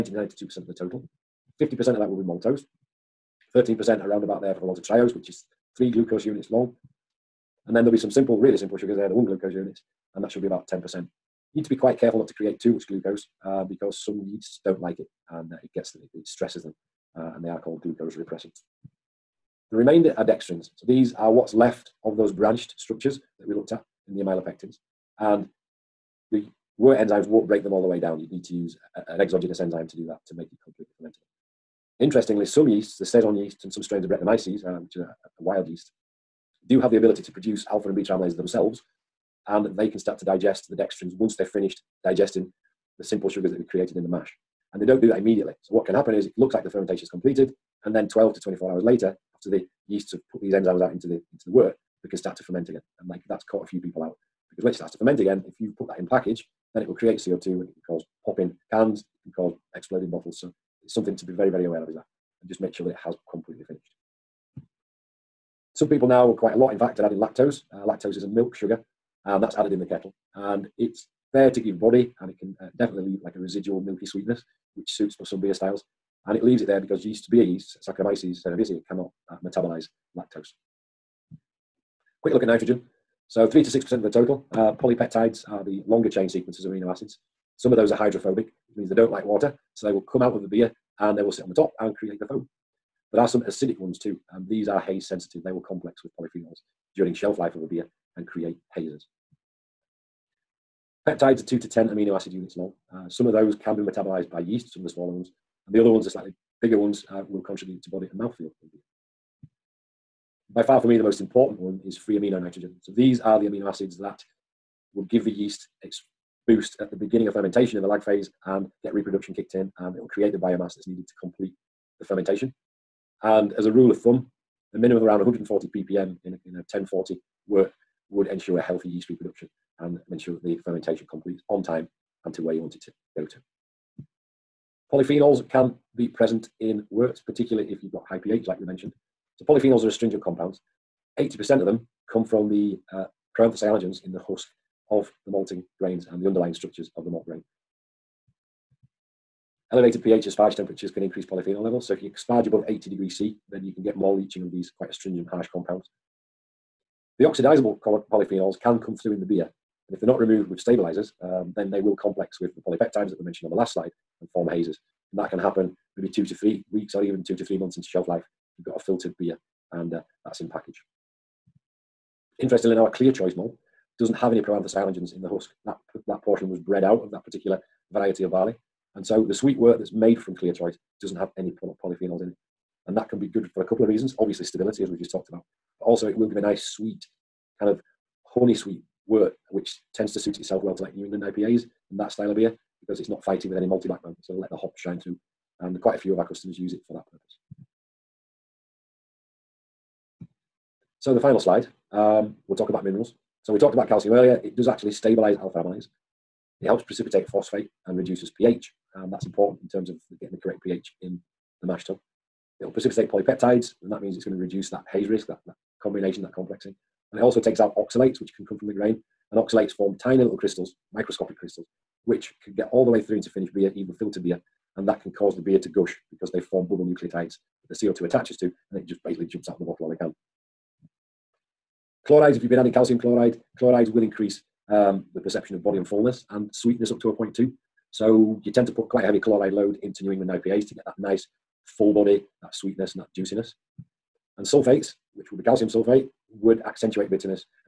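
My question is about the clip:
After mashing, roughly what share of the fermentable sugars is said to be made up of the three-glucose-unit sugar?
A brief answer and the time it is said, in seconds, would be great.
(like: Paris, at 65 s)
13%, at 3 s.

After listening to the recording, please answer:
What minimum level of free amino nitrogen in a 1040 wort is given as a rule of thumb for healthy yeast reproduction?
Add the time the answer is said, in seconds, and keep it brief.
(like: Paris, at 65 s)
140 ppm, at 125 s.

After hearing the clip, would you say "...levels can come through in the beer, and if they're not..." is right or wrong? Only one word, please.
wrong.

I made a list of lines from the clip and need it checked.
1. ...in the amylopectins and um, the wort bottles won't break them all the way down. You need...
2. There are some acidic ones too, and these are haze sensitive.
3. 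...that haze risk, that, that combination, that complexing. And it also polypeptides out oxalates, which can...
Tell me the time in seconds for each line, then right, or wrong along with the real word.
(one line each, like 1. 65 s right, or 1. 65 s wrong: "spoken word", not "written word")
1. 24 s wrong: "enzymes", not "bottles"
2. 93 s right
3. 214 s wrong: "takes", not "polypeptides".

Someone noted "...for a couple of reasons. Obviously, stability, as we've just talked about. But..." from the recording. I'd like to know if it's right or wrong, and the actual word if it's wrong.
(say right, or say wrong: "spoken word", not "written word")
right.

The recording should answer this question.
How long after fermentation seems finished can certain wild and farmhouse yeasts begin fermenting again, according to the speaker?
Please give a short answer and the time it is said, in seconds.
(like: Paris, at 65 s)
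12 to 24 hours, at 48 s.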